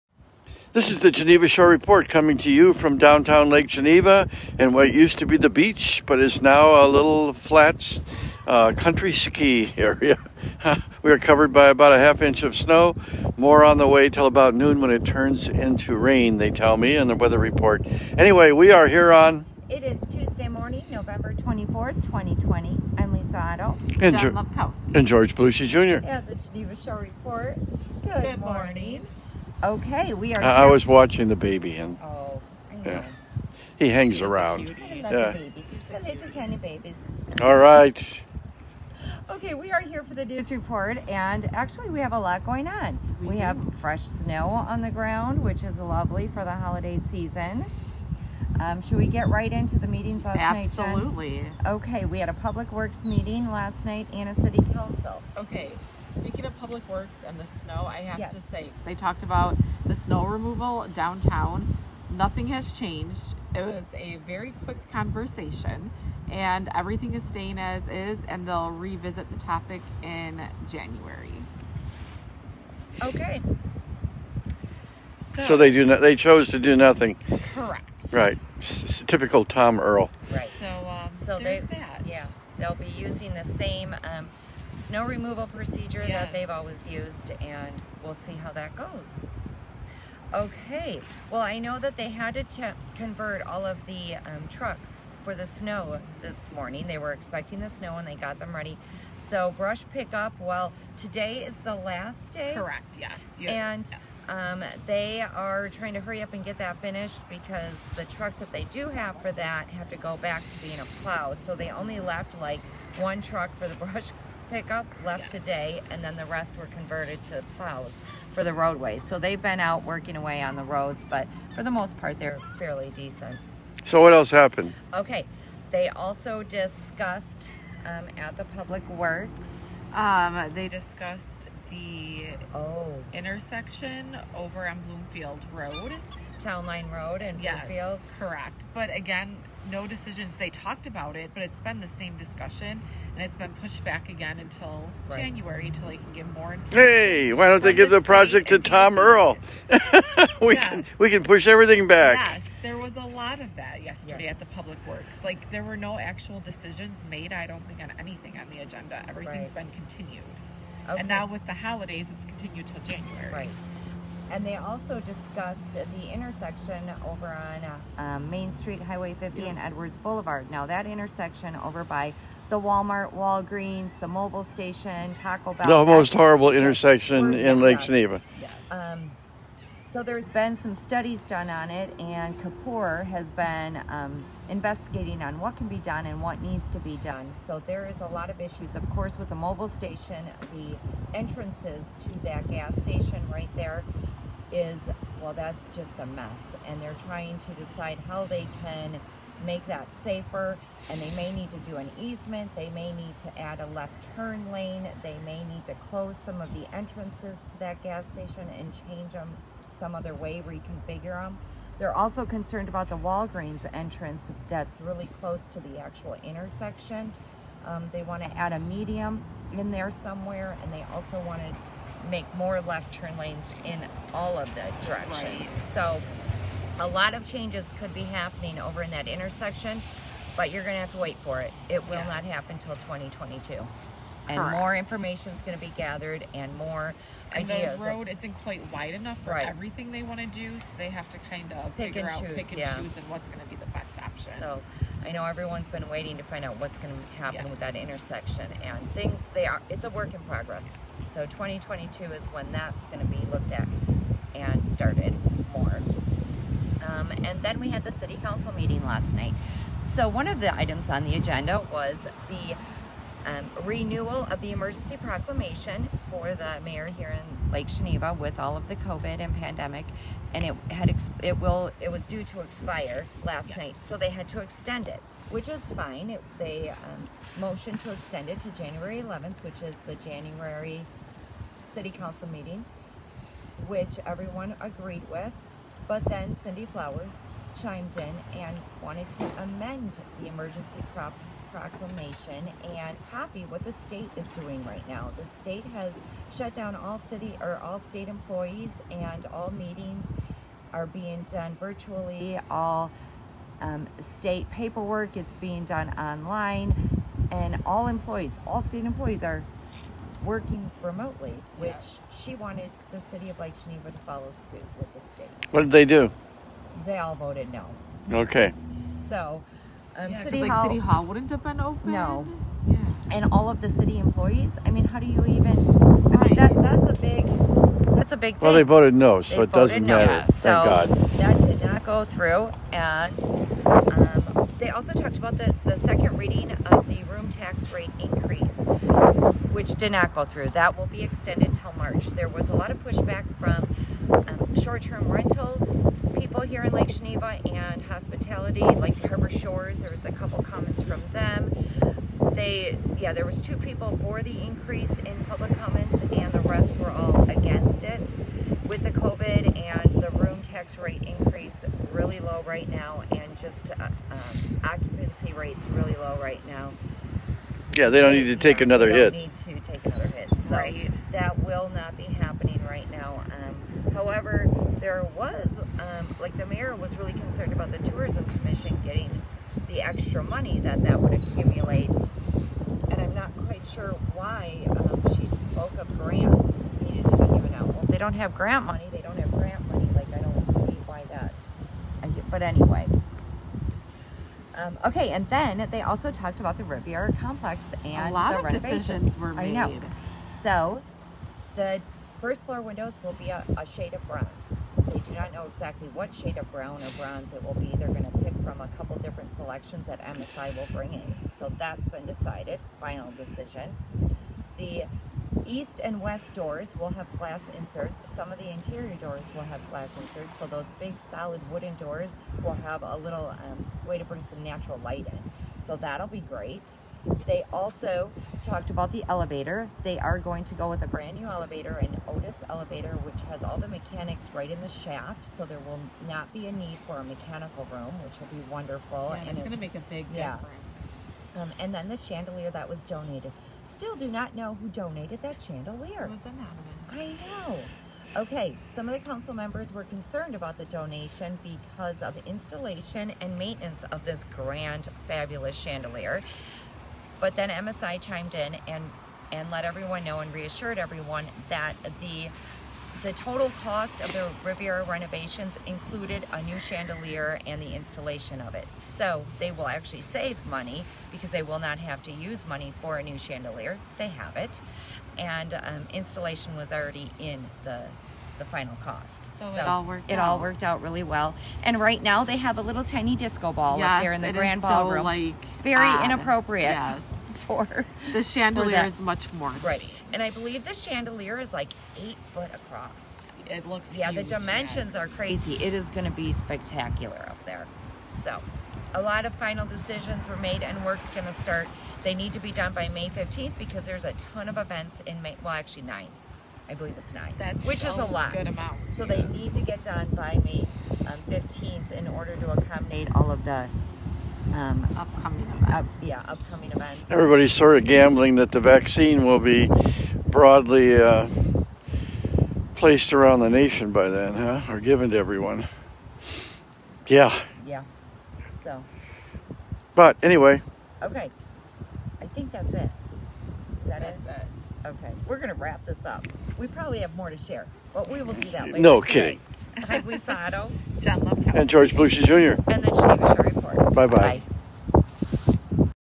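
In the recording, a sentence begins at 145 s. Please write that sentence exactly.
January until they can get more.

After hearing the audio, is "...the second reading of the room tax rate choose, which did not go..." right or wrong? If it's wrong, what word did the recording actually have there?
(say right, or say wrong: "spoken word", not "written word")
wrong: "increase", not "choose".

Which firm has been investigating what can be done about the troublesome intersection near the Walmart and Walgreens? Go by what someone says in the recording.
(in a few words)
Kapur.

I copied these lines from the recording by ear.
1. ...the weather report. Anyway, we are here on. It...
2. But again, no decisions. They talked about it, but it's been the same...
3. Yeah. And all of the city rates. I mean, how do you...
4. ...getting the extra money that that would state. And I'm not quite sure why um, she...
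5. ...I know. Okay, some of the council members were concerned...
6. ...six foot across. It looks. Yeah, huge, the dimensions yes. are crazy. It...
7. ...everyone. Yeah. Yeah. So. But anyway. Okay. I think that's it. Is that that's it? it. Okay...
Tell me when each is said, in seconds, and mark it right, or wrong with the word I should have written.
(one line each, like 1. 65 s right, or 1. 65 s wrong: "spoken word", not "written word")
1. 17 s right
2. 138 s right
3. 322 s wrong: "employees", not "rates"
4. 378 s wrong: "accumulate", not "state"
5. 446 s right
6. 492 s wrong: "eight", not "six"
7. 525 s right.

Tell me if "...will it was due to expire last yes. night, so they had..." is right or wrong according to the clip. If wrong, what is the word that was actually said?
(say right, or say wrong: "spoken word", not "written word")
right.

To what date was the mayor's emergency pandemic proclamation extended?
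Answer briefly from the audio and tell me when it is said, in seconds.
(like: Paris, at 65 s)
January 11th, at 278 s.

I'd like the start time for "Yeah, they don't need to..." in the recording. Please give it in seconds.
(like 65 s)
367 s.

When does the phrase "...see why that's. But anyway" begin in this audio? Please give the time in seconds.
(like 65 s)
390 s.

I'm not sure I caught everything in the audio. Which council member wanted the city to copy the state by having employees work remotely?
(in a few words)
Cindy Flower.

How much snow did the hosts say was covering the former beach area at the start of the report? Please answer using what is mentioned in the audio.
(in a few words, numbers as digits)
half inch.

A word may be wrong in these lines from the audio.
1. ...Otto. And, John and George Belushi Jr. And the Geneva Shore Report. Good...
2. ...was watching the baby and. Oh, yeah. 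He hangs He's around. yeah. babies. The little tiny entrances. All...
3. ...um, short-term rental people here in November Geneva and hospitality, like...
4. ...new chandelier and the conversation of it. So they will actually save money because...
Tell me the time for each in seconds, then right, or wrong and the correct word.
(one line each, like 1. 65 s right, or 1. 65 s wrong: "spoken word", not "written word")
1. 23 s right
2. 30 s wrong: "babies", not "entrances"
3. 344 s wrong: "Lake", not "November"
4. 466 s wrong: "installation", not "conversation".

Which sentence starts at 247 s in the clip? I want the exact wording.
with that intersection, and things they are.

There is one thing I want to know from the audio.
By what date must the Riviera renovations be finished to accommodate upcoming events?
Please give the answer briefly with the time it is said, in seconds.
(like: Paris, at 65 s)
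May 15th, at 502 s.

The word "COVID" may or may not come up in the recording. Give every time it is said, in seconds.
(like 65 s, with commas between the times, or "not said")
268 s, 358 s.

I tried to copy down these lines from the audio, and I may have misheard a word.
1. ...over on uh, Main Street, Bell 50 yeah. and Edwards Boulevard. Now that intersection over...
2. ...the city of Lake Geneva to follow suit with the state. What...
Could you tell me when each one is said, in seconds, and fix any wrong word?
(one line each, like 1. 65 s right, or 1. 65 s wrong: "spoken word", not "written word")
1. 167 s wrong: "Highway", not "Bell"
2. 312 s right.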